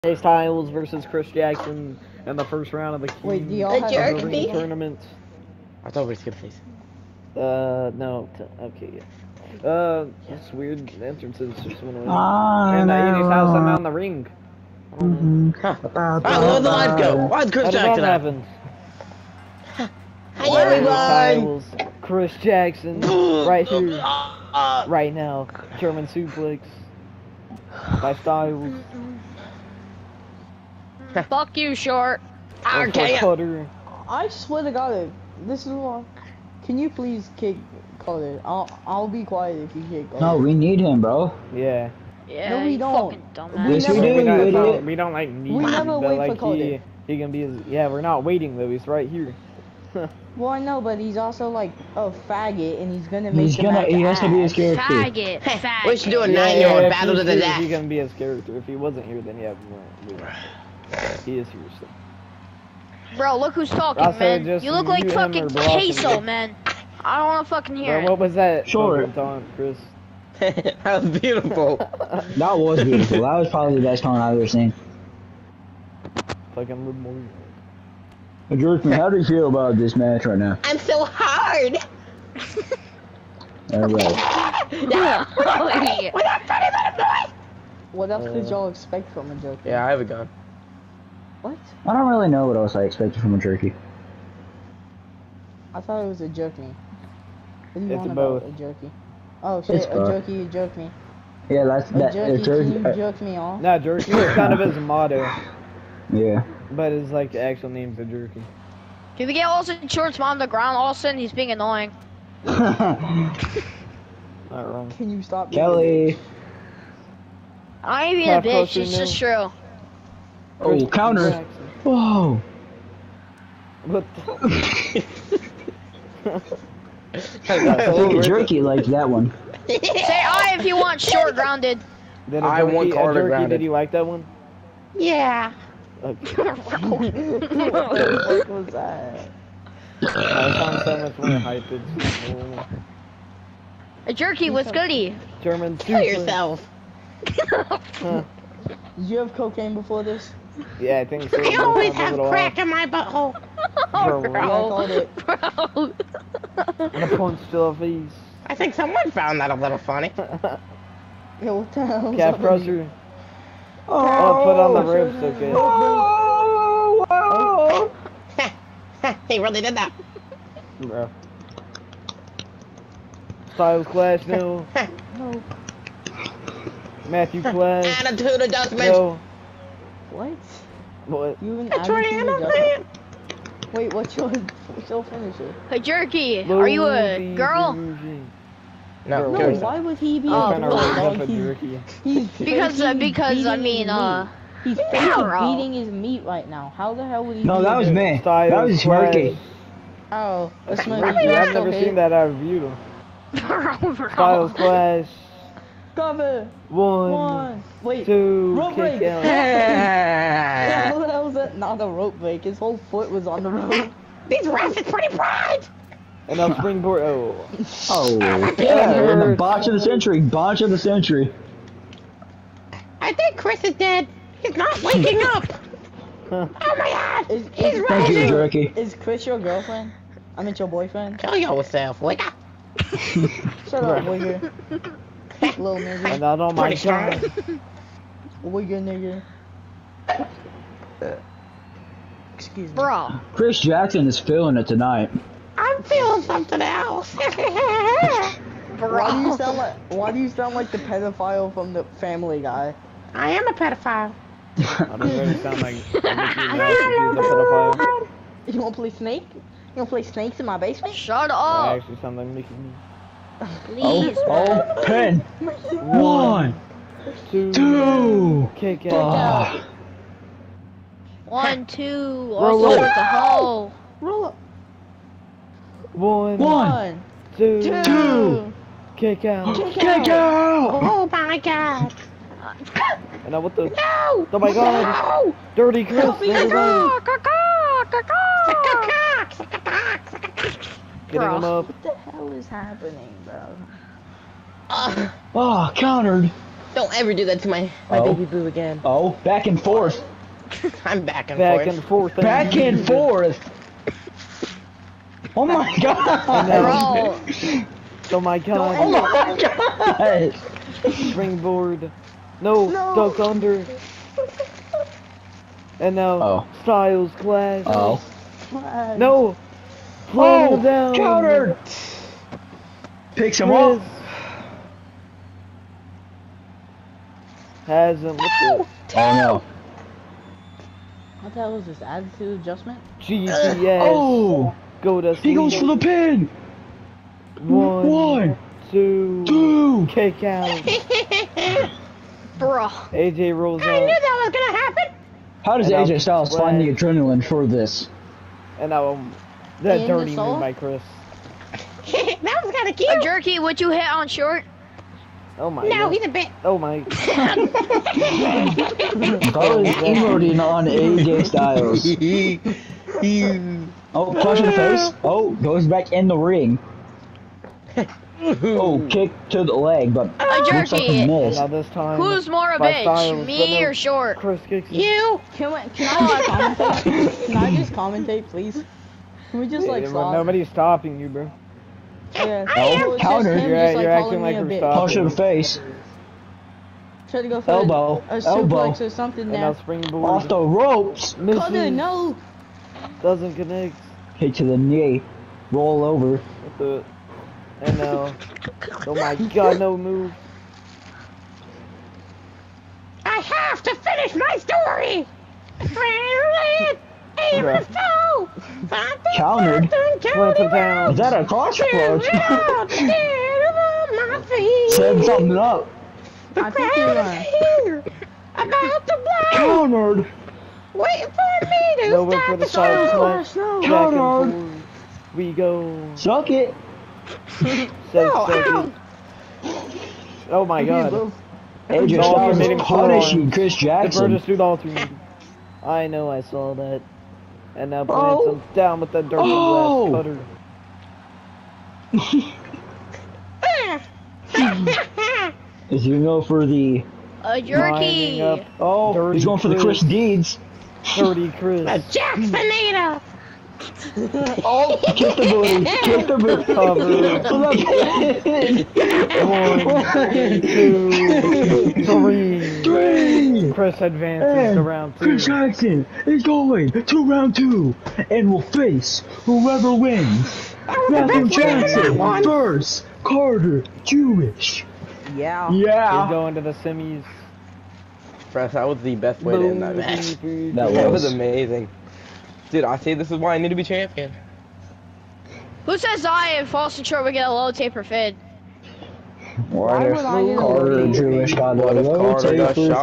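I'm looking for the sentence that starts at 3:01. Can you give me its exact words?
You and Abby Wait, what's your what's your finisher?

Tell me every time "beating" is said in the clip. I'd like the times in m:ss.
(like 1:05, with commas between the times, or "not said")
3:15.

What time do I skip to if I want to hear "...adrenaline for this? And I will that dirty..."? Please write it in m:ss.
5:46.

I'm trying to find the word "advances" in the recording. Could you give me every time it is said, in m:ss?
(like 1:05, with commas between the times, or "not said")
7:43.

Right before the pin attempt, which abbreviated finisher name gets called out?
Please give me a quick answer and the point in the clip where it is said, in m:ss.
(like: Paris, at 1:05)
GTS, at 5:32.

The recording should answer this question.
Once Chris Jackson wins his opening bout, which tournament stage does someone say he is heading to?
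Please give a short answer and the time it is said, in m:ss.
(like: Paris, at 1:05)
the semis, at 7:56.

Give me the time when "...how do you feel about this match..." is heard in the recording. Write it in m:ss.
1:18.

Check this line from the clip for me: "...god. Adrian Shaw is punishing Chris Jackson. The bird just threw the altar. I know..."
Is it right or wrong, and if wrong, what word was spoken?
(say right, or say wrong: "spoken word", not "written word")
right.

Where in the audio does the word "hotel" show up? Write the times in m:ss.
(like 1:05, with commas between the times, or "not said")
not said.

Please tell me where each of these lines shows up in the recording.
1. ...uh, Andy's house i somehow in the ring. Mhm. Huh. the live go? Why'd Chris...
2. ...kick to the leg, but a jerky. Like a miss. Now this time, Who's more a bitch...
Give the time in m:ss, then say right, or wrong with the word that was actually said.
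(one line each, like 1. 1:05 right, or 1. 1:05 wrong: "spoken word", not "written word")
1. 0:12 right
2. 6:08 right.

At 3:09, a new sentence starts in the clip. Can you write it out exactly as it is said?
No, no why would he be oh, a like jerky?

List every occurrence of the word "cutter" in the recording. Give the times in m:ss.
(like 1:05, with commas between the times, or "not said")
6:31, 7:24.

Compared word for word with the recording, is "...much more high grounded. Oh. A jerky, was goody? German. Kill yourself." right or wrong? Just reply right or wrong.
wrong.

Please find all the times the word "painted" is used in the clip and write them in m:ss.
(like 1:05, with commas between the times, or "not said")
not said.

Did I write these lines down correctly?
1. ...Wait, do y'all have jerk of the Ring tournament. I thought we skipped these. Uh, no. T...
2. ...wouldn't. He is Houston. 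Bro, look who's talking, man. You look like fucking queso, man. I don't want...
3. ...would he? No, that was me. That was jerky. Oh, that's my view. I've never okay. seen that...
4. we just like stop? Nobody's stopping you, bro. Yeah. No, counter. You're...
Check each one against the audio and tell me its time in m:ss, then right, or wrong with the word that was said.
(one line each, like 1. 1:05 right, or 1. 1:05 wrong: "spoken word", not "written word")
1. 0:03 right
2. 1:00 right
3. 3:17 right
4. 6:19 right.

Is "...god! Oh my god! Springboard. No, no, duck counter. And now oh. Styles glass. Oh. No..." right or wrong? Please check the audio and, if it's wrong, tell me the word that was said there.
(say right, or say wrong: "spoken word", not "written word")
wrong: "under", not "counter".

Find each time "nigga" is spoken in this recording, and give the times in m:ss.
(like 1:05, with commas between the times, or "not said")
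3:55, 4:00.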